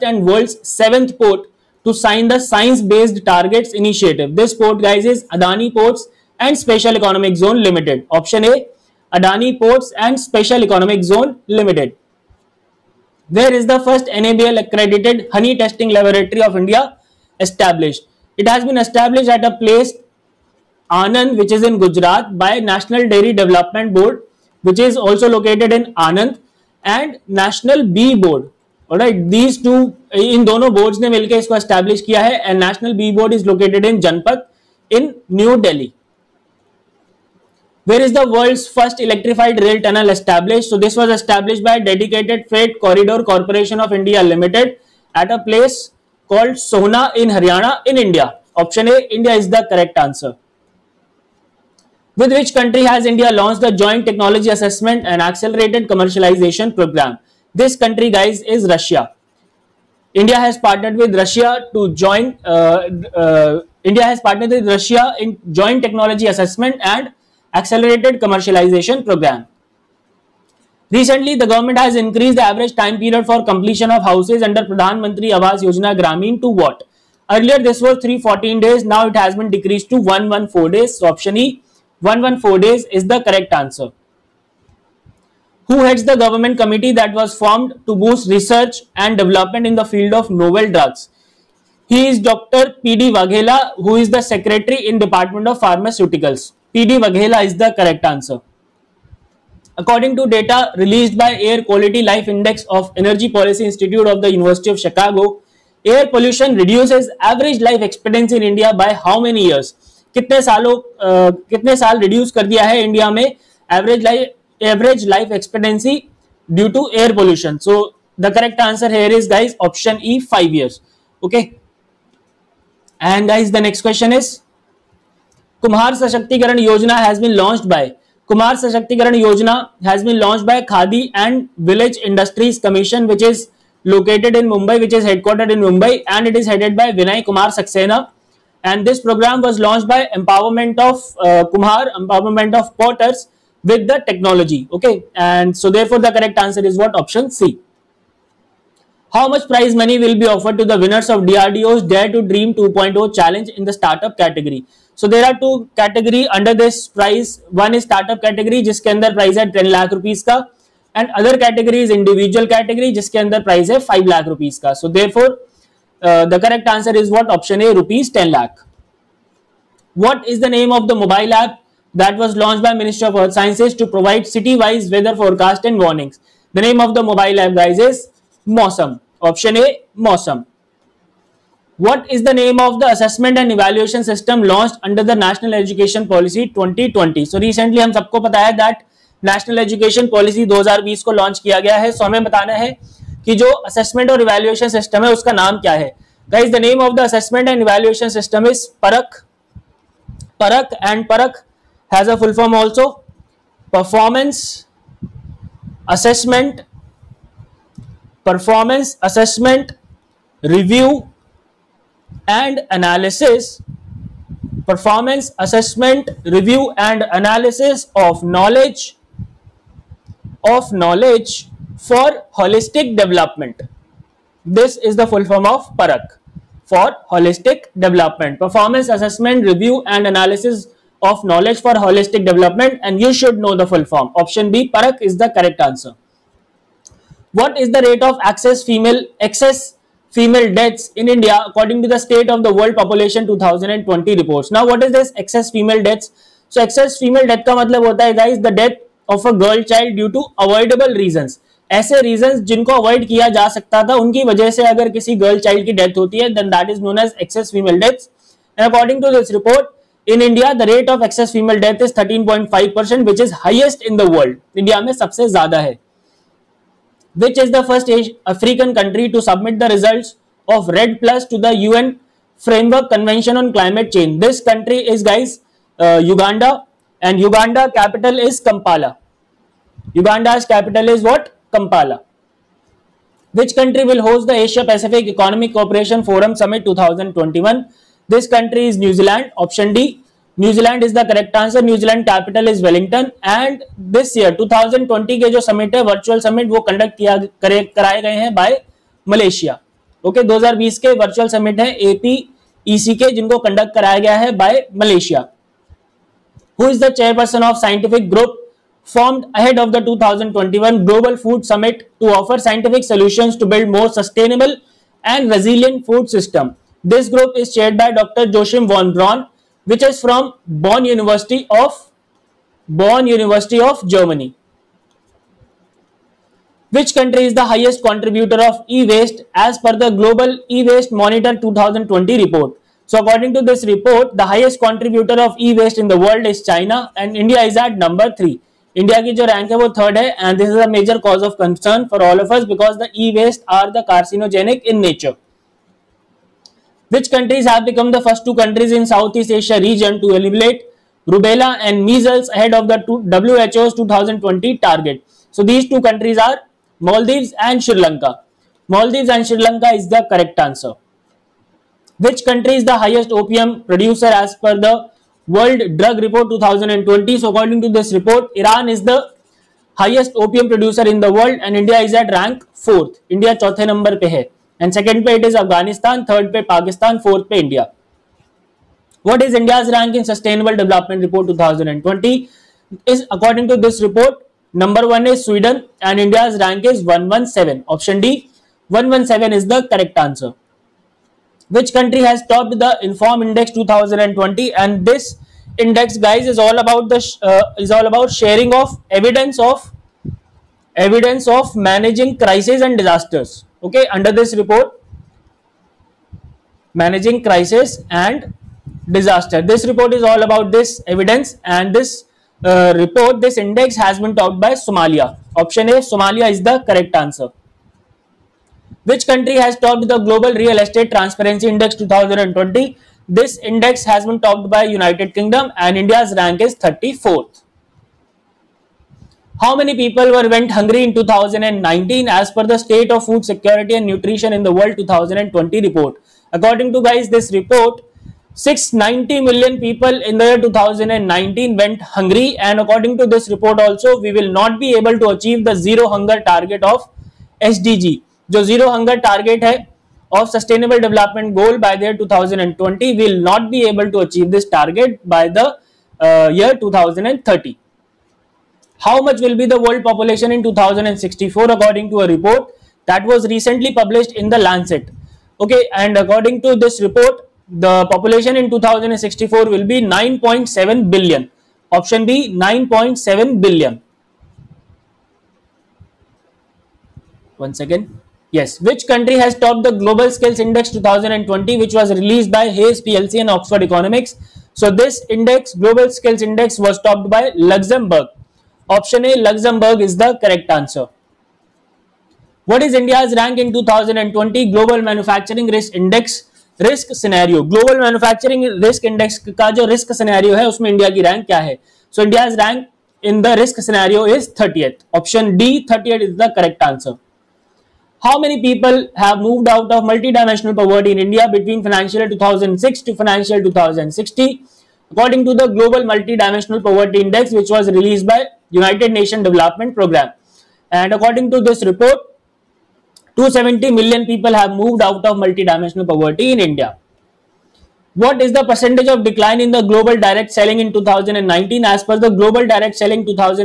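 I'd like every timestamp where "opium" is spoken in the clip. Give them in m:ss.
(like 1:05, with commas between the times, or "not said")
6:03, 6:10.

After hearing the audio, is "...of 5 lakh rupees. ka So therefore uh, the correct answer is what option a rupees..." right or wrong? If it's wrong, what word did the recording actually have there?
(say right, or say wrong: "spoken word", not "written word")
right.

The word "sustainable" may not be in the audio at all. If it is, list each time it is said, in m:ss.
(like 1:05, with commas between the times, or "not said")
5:13, 6:20, 7:30.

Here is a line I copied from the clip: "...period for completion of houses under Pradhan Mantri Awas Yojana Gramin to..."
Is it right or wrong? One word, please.
right.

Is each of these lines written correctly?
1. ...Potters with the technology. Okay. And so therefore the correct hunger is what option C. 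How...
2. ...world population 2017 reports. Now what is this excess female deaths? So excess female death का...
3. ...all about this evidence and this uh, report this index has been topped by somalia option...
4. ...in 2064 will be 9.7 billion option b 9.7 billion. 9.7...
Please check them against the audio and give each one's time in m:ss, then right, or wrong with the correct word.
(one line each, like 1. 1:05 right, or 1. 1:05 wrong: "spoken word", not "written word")
1. 2:22 wrong: "answer", not "hunger"
2. 4:02 wrong: "2020", not "2017"
3. 6:50 right
4. 7:48 right.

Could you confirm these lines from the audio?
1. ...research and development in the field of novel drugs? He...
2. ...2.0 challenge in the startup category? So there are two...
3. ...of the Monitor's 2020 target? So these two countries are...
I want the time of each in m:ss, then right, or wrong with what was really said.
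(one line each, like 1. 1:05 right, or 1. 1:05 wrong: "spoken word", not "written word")
1. 1:28 right
2. 2:32 right
3. 5:52 wrong: "WHO", not "Monitor".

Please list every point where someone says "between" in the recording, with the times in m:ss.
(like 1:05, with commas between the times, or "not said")
8:31.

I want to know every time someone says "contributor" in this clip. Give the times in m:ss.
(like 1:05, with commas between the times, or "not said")
5:27, 5:34.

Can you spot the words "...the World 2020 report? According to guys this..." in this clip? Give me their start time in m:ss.
7:14.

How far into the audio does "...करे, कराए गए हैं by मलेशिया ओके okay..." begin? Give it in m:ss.
4:57.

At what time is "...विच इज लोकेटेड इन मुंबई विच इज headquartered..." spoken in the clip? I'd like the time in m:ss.
2:13.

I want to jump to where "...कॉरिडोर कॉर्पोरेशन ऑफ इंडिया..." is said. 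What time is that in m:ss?
0:42.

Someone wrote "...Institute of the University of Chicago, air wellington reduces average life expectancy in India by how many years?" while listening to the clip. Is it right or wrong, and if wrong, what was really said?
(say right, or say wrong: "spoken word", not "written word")
wrong: "pollution", not "wellington".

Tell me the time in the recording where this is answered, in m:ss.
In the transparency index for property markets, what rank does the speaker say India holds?
7:06.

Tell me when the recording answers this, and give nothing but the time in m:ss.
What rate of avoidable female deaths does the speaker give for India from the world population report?
4:21.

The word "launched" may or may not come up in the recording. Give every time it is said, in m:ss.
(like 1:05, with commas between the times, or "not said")
0:53, 2:19, 2:52, 3:04.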